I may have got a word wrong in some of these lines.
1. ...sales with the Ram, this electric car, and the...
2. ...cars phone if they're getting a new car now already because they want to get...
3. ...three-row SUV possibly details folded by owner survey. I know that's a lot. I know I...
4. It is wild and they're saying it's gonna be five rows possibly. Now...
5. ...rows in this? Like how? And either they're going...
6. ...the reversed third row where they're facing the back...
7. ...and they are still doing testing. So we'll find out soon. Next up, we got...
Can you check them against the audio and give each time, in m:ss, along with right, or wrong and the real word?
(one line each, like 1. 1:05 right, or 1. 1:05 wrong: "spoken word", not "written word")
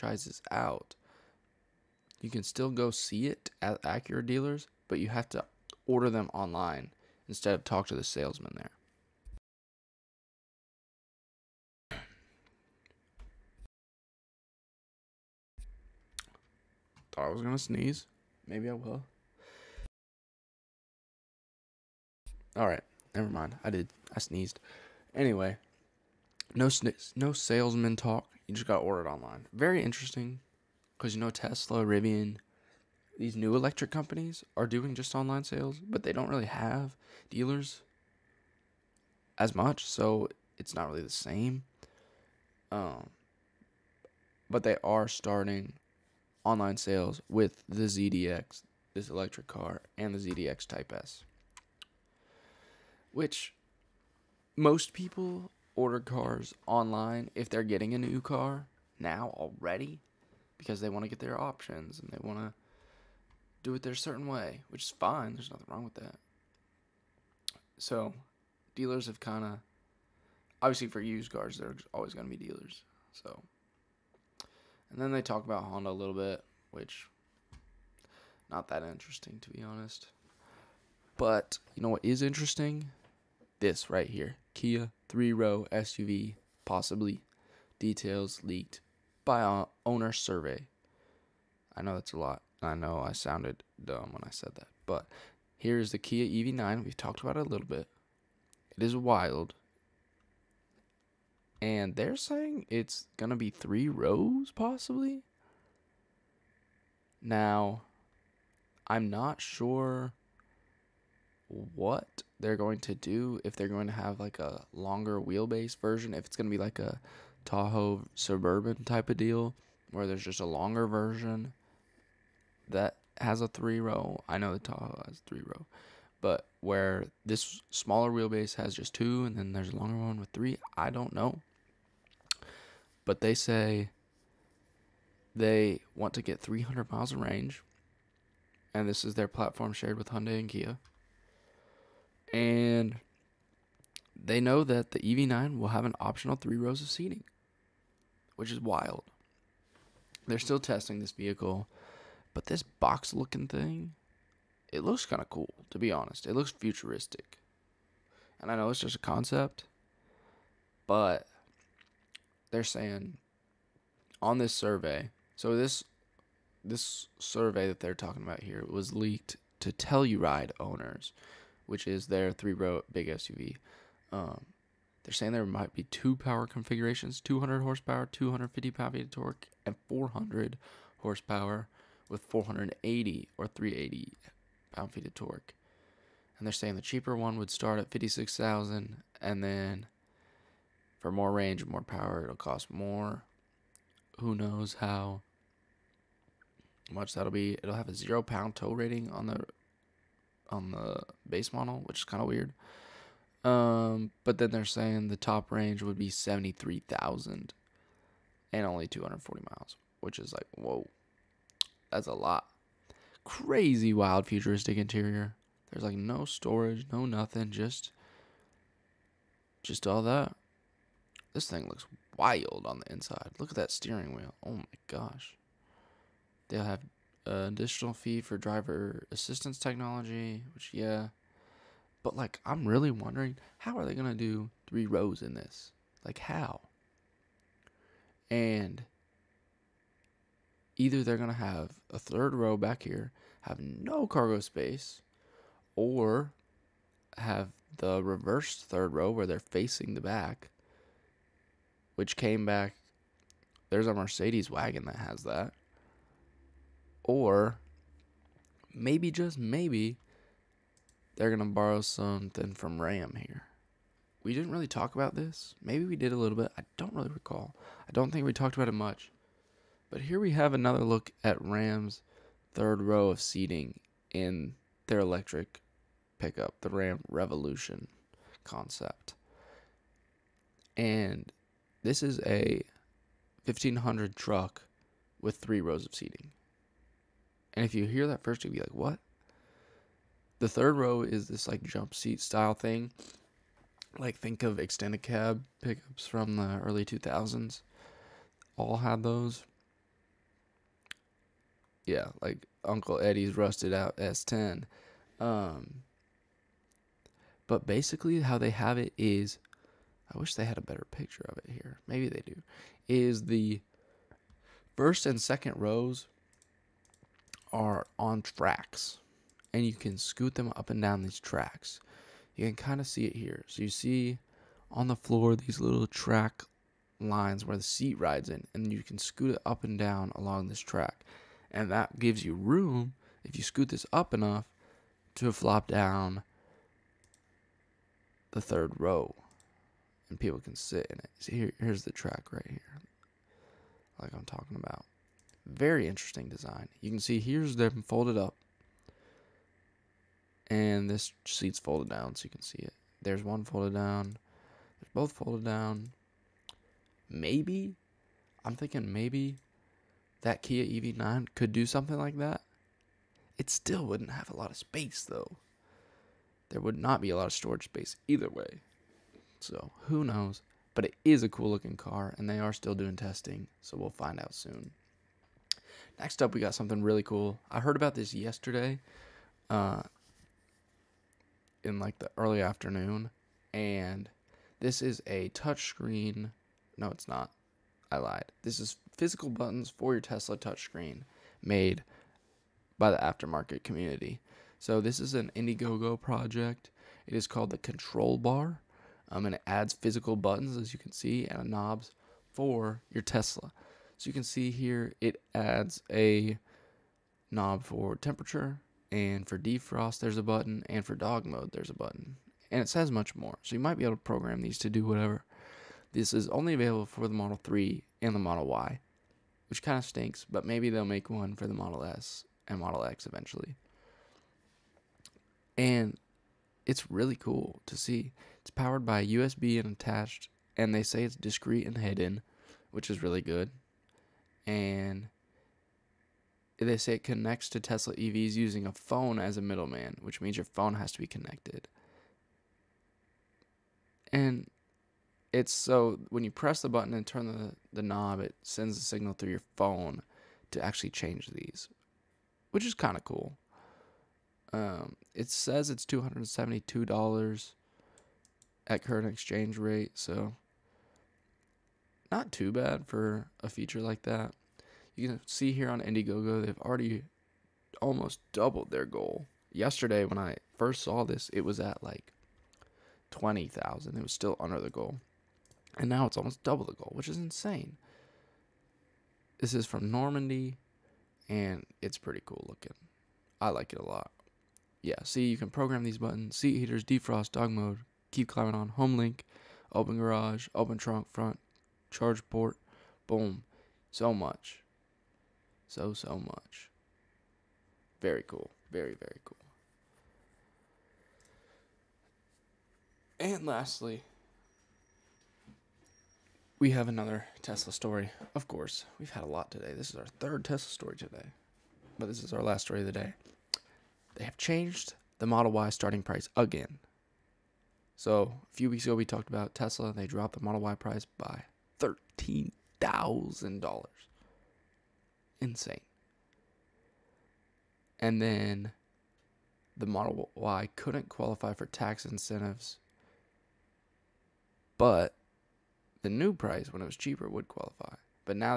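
1. 0:46 wrong: "ZDX", not "Ram"
2. 0:55 wrong: "online", not "phone"
3. 1:25 wrong: "leaked", not "folded"
4. 1:38 wrong: "three", not "five"
5. 3:54 right
6. 4:07 right
7. 6:12 right.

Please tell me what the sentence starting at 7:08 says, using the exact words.
It's powered by USB and attached, and they say it's discreet and hidden, which is really good.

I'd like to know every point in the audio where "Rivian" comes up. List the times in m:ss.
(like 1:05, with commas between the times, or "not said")
0:31.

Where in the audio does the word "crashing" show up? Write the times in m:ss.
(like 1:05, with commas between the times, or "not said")
not said.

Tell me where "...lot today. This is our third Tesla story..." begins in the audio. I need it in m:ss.
8:29.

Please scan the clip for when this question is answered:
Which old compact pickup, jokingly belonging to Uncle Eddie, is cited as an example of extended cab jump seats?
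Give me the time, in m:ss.
5:03.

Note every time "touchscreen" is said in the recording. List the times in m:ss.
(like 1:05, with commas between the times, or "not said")
6:25, 6:30.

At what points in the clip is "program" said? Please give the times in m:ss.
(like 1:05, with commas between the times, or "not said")
6:54, 8:05.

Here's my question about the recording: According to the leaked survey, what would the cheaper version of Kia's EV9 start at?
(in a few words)
56,000.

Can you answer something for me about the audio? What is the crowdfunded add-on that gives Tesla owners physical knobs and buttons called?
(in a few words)
Control Bar.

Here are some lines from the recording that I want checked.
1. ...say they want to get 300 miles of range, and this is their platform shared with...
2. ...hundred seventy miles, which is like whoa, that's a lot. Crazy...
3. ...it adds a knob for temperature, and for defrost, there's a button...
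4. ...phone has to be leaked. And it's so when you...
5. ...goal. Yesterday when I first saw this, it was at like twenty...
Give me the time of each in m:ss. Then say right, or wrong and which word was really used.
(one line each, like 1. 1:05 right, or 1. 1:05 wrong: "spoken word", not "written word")
1. 2:13 right
2. 3:29 wrong: "forty", not "seventy"
3. 6:44 right
4. 7:20 wrong: "connected", not "leaked"
5. 7:48 right.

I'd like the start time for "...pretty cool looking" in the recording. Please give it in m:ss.
8:01.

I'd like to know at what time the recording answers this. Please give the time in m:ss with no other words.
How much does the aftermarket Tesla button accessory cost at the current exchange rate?
7:35.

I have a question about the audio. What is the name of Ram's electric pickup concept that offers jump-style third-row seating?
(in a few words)
Ram Revolution.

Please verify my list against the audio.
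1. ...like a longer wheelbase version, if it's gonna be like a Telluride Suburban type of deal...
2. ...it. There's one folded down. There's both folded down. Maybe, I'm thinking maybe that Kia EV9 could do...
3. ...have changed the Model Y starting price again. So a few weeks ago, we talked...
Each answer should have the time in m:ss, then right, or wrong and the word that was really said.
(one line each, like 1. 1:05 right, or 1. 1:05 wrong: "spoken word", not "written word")
1. 1:54 wrong: "Tahoe", not "Telluride"
2. 5:52 right
3. 8:34 right.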